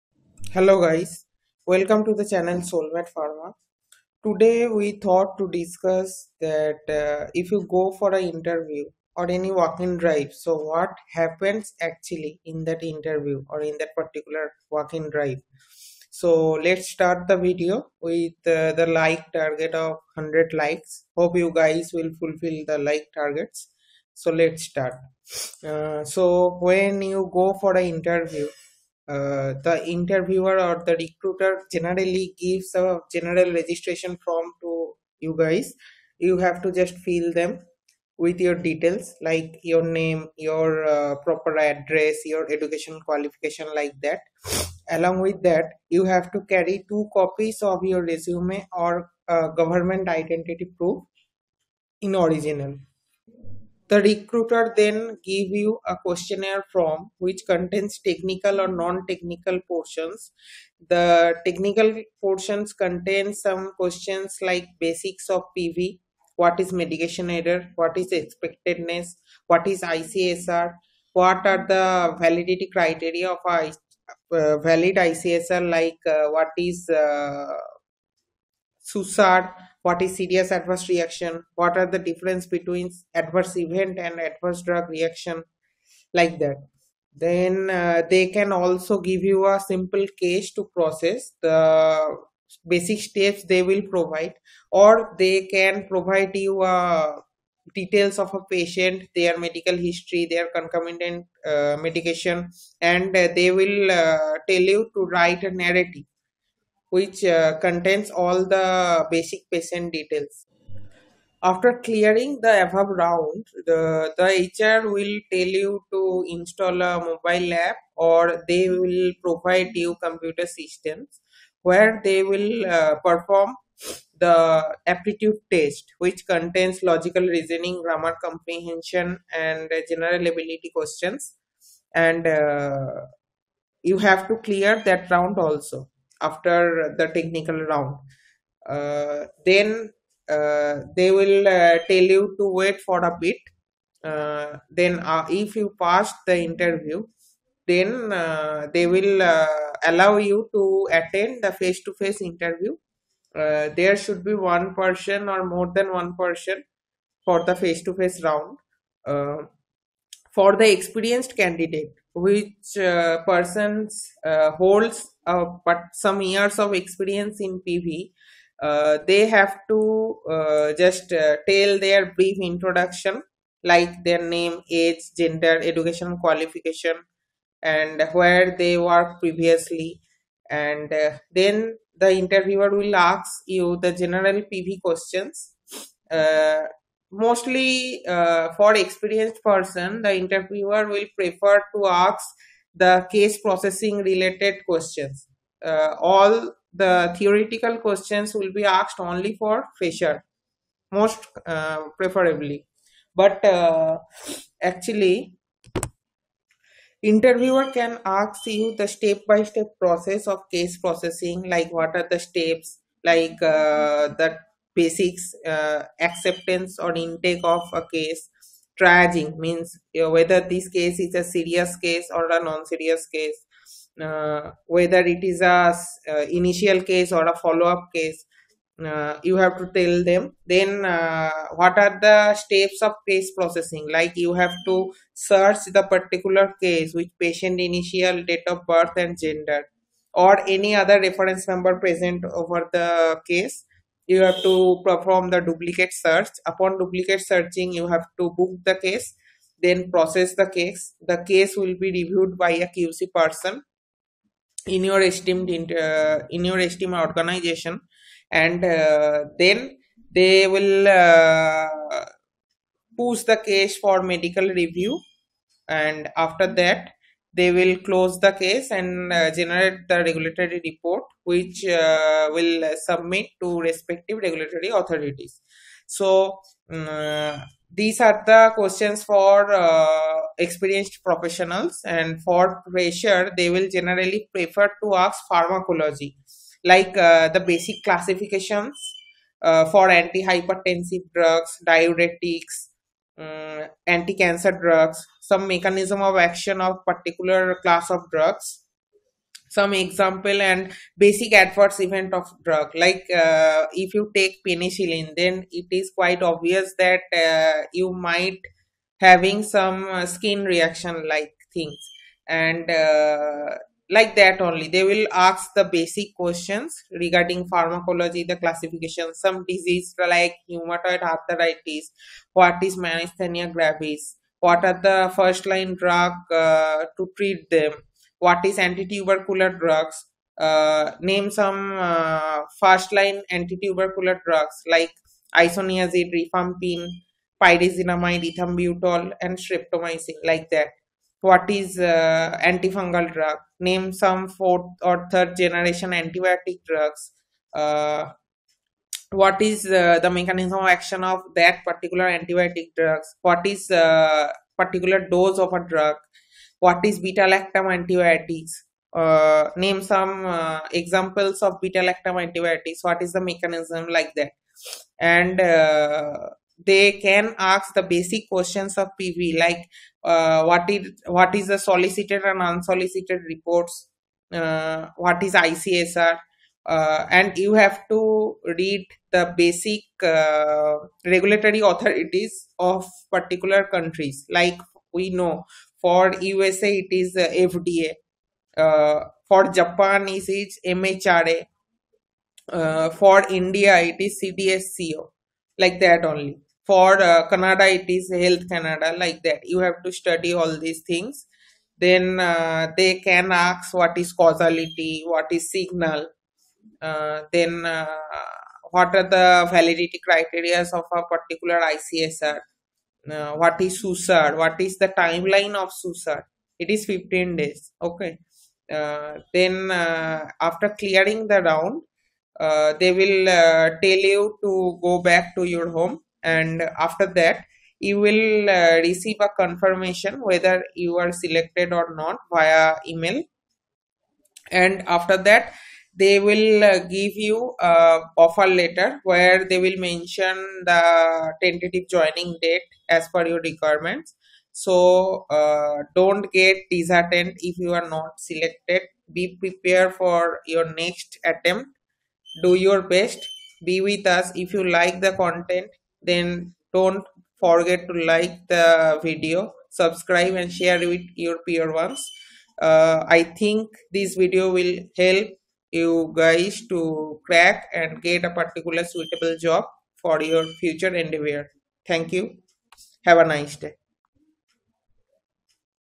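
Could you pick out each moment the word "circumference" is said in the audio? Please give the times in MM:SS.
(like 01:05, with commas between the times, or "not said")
not said.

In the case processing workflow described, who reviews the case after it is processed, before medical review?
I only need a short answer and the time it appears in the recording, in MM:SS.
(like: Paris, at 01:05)
QC person, at 04:12.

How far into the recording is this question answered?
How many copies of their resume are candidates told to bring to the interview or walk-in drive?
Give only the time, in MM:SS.
00:46.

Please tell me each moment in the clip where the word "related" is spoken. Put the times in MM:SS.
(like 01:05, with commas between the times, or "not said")
03:13.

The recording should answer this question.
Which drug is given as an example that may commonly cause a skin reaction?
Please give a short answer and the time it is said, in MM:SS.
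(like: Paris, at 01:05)
Penicillin, at 05:04.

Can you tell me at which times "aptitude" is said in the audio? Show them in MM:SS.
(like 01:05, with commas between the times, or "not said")
02:04.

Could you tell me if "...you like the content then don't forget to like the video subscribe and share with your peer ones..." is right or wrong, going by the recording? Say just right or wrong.
right.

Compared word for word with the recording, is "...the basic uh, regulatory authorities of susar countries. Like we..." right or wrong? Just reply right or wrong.
wrong.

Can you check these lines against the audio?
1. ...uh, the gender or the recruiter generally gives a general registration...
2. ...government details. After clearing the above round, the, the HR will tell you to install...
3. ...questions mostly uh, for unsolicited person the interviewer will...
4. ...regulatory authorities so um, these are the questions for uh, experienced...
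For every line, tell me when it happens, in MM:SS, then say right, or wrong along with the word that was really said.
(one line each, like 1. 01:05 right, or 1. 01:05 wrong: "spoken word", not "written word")
1. 00:29 wrong: "interviewer", not "gender"
2. 01:49 wrong: "patient", not "government"
3. 03:04 wrong: "experienced", not "unsolicited"
4. 04:34 right.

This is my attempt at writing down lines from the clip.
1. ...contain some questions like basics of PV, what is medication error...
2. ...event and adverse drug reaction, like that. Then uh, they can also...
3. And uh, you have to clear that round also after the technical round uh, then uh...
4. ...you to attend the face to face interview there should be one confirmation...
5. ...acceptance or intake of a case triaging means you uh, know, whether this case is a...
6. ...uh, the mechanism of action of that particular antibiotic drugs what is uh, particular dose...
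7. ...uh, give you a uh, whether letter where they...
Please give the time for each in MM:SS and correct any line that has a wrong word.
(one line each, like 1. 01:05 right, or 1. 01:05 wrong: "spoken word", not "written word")
1. 01:02 right
2. 01:23 right
3. 02:11 right
4. 02:30 wrong: "person", not "confirmation"
5. 03:35 right
6. 05:49 right
7. 07:16 wrong: "offer", not "whether".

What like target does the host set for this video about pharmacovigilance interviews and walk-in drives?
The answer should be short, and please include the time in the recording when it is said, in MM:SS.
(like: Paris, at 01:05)
100 likes, at 00:20.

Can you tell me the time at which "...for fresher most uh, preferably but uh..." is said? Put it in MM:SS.
03:19.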